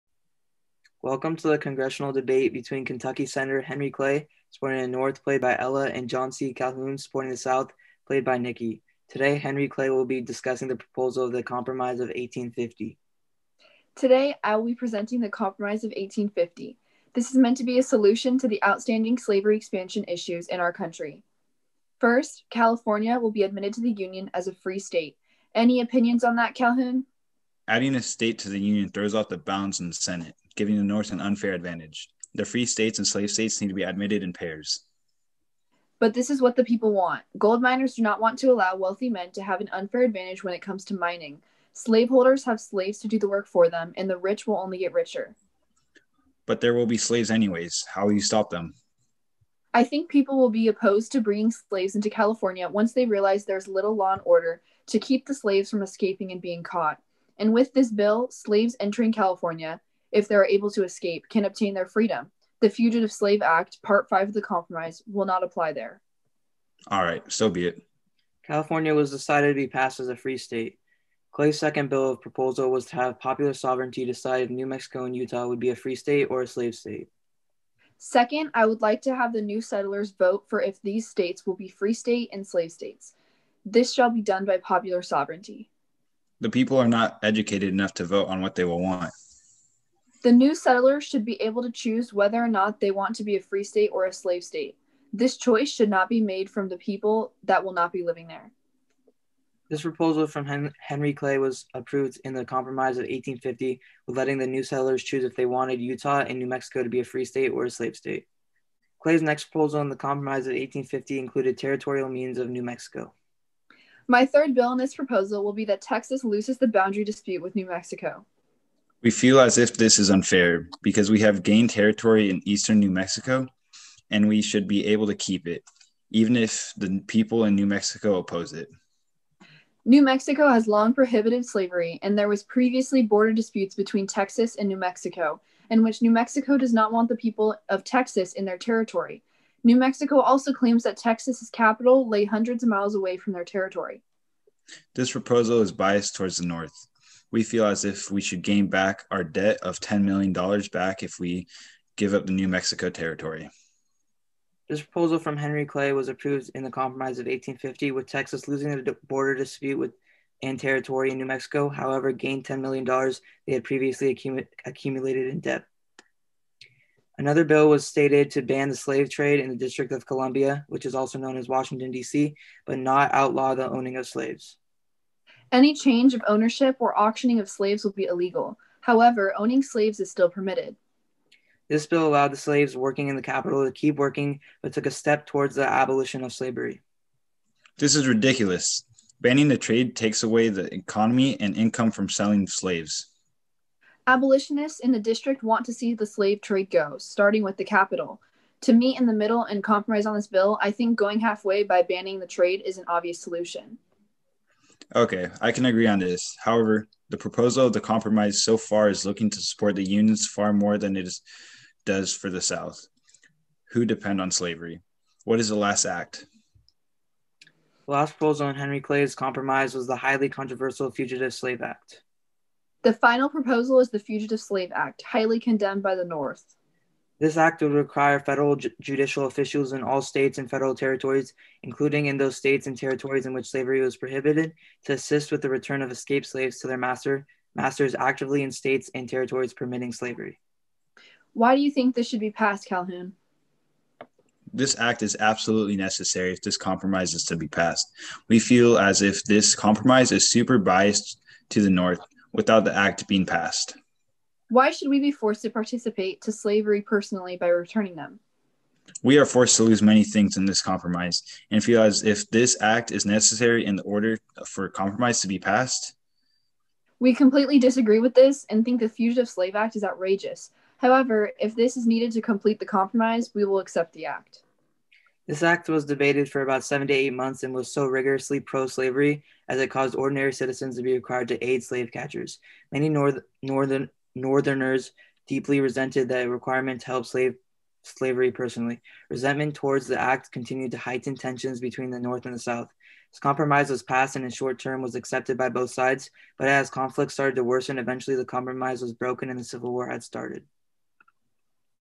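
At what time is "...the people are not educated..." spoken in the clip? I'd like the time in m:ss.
1:26.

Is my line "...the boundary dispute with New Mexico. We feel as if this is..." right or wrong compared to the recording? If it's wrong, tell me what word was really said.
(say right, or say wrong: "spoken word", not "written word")
right.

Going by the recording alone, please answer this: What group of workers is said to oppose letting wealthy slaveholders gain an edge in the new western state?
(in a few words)
Gold miners.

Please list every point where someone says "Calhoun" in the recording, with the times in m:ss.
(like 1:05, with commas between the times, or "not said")
0:06, 0:26, 4:02.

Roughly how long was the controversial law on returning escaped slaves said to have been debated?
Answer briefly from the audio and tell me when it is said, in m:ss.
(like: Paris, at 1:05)
Seven to eight months, at 4:36.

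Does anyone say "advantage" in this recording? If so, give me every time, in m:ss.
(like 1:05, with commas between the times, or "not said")
0:31, 0:40.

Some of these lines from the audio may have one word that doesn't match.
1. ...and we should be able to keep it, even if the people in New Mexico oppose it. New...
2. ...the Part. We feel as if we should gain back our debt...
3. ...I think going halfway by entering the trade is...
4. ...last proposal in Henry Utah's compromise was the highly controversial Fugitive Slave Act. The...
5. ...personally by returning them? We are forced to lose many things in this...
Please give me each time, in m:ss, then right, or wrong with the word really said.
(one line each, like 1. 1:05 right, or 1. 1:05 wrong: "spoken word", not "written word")
1. 2:04 right
2. 2:26 wrong: "North", not "Part"
3. 3:20 wrong: "banning", not "entering"
4. 3:37 wrong: "Clay", not "Utah"
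5. 4:16 right.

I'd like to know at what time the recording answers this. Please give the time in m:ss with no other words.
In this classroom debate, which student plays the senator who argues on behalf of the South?
0:08.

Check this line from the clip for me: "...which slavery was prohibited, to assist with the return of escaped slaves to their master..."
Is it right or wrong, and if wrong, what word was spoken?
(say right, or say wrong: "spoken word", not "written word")
right.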